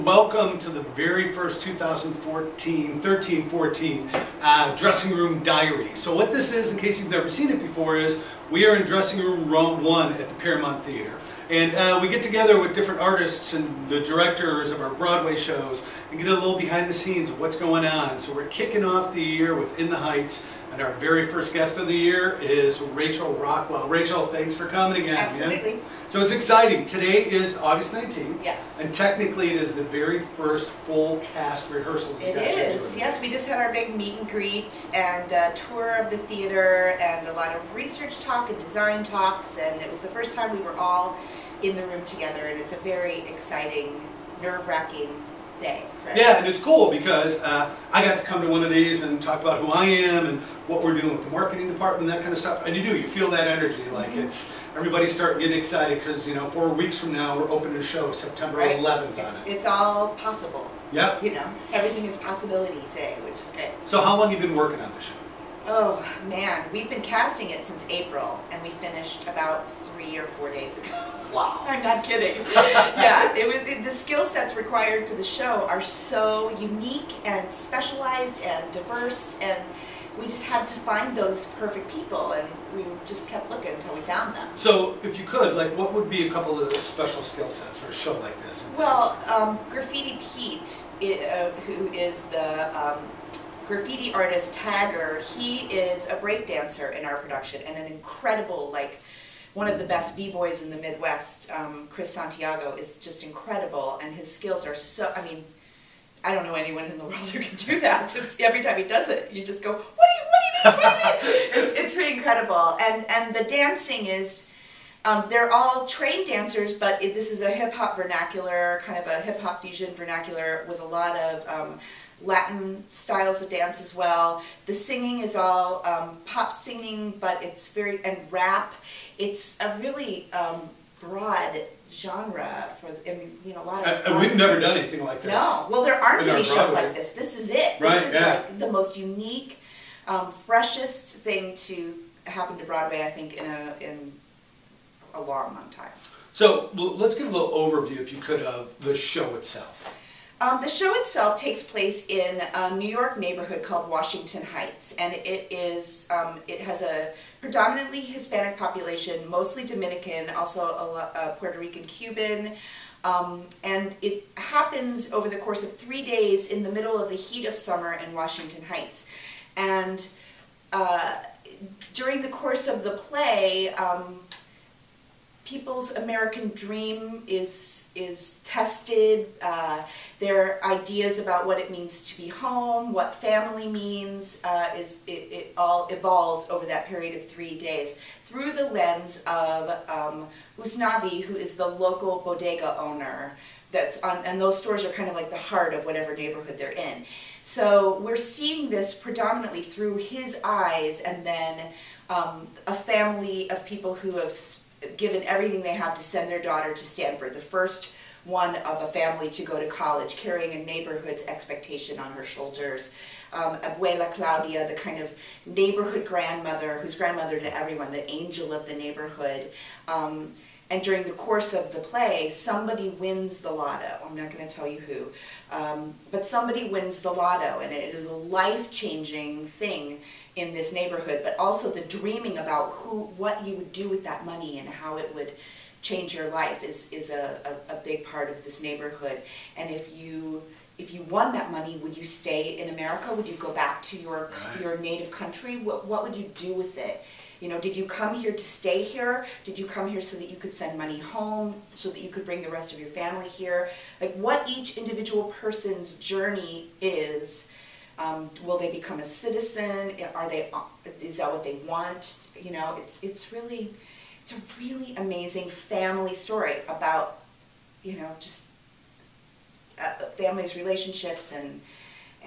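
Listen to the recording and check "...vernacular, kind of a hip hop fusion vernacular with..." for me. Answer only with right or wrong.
right.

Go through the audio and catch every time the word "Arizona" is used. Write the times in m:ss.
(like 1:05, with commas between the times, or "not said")
not said.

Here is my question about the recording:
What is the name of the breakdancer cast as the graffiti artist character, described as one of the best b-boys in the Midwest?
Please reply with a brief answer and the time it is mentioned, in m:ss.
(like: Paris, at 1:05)
Chris Santiago, at 1:41.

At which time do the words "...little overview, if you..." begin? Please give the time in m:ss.
2:27.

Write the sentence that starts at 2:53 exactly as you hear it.
Um, people's American dream is is tested.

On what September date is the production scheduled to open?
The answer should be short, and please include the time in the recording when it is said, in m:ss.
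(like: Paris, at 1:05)
September 11th, at 0:58.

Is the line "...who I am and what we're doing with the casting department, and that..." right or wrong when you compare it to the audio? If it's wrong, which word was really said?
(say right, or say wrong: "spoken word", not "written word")
wrong: "marketing", not "casting".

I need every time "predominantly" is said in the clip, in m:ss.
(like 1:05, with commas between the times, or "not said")
2:37, 3:18.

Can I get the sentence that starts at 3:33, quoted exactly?
Um, Abuela Claudia, the kind of neighborhood grandmother, who's grandmother to everyone, the angel of the neighborhood.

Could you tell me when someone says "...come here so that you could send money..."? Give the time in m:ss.
4:09.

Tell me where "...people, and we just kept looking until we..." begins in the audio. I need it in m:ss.
1:21.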